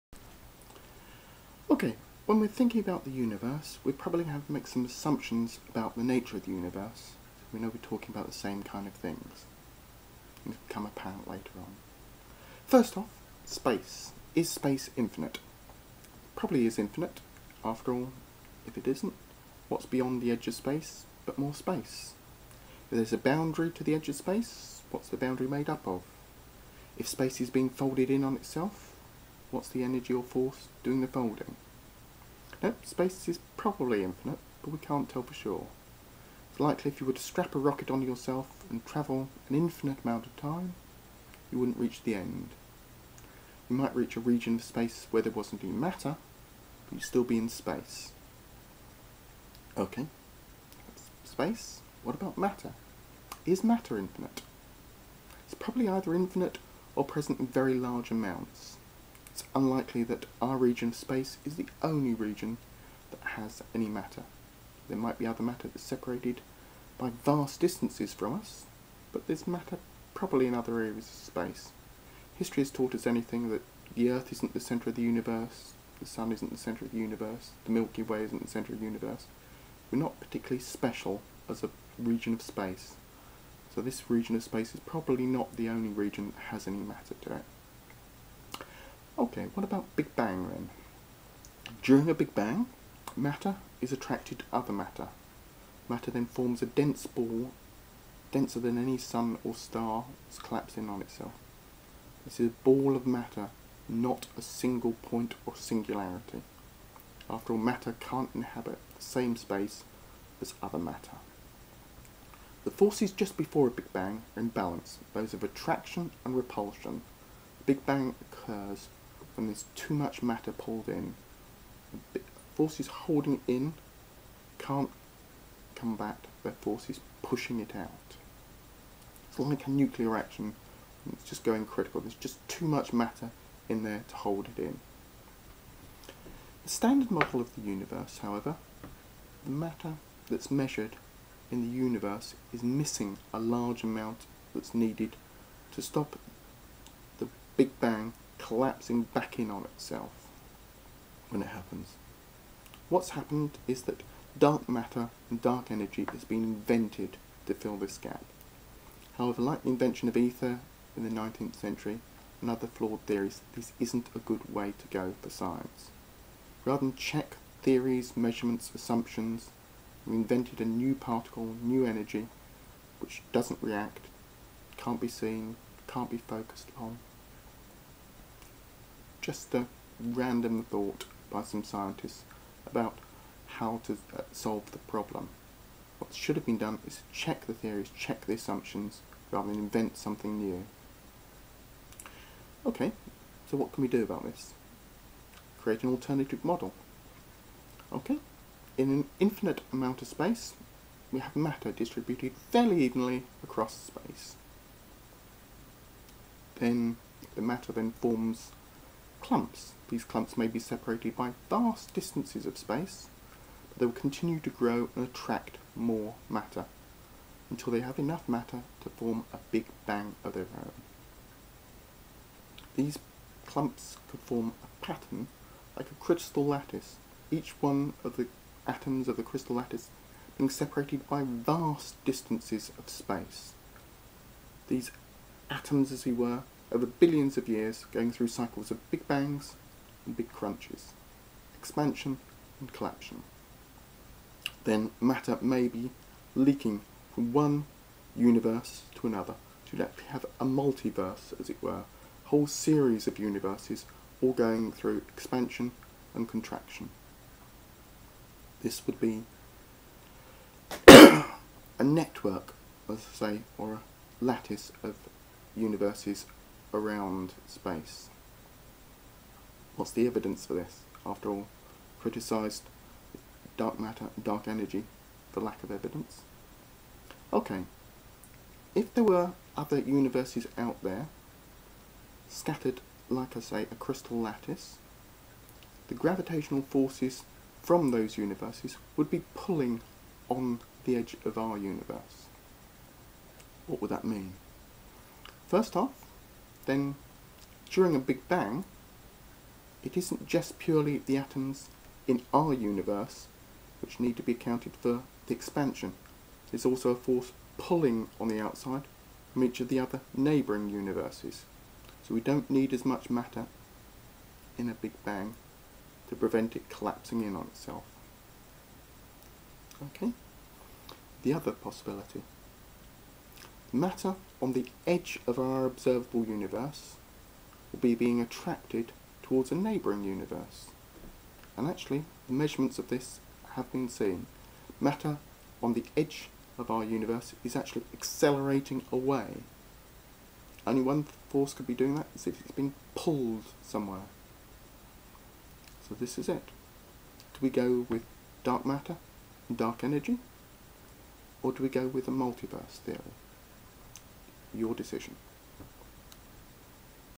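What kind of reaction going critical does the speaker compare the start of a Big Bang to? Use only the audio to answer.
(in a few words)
nuclear reaction.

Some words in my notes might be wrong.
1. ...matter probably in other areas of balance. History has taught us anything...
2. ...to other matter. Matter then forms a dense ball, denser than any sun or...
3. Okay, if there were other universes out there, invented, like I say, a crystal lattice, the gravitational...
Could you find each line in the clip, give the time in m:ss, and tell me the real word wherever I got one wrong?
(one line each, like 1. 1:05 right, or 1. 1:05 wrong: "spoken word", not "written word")
1. 1:09 wrong: "space", not "balance"
2. 1:34 right
3. 4:37 wrong: "scattered", not "invented".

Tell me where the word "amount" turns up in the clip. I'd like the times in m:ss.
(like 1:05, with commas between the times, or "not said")
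0:40, 0:58, 2:23, 3:19.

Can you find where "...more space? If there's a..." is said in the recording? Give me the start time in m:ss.
0:21.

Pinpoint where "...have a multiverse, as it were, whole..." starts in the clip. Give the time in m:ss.
4:10.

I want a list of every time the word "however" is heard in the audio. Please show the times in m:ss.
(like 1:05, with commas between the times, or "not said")
2:18, 2:39.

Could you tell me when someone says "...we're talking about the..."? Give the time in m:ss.
0:07.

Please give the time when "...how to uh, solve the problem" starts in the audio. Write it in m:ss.
3:03.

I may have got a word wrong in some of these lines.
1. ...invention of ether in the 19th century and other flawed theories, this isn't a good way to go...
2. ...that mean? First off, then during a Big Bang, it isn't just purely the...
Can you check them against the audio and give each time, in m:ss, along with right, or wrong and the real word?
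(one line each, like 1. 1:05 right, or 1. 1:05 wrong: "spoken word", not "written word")
1. 2:39 right
2. 4:53 right.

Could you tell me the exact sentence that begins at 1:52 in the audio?
The forces just before a Big Bang are in balance, those of attraction and repulsion.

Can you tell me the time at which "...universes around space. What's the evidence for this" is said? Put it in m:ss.
4:25.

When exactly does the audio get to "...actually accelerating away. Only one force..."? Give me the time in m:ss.
5:37.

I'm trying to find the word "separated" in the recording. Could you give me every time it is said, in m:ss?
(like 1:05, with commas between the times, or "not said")
1:05, 3:30, 3:50.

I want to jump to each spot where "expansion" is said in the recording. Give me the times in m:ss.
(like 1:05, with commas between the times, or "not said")
4:01, 4:15, 5:05.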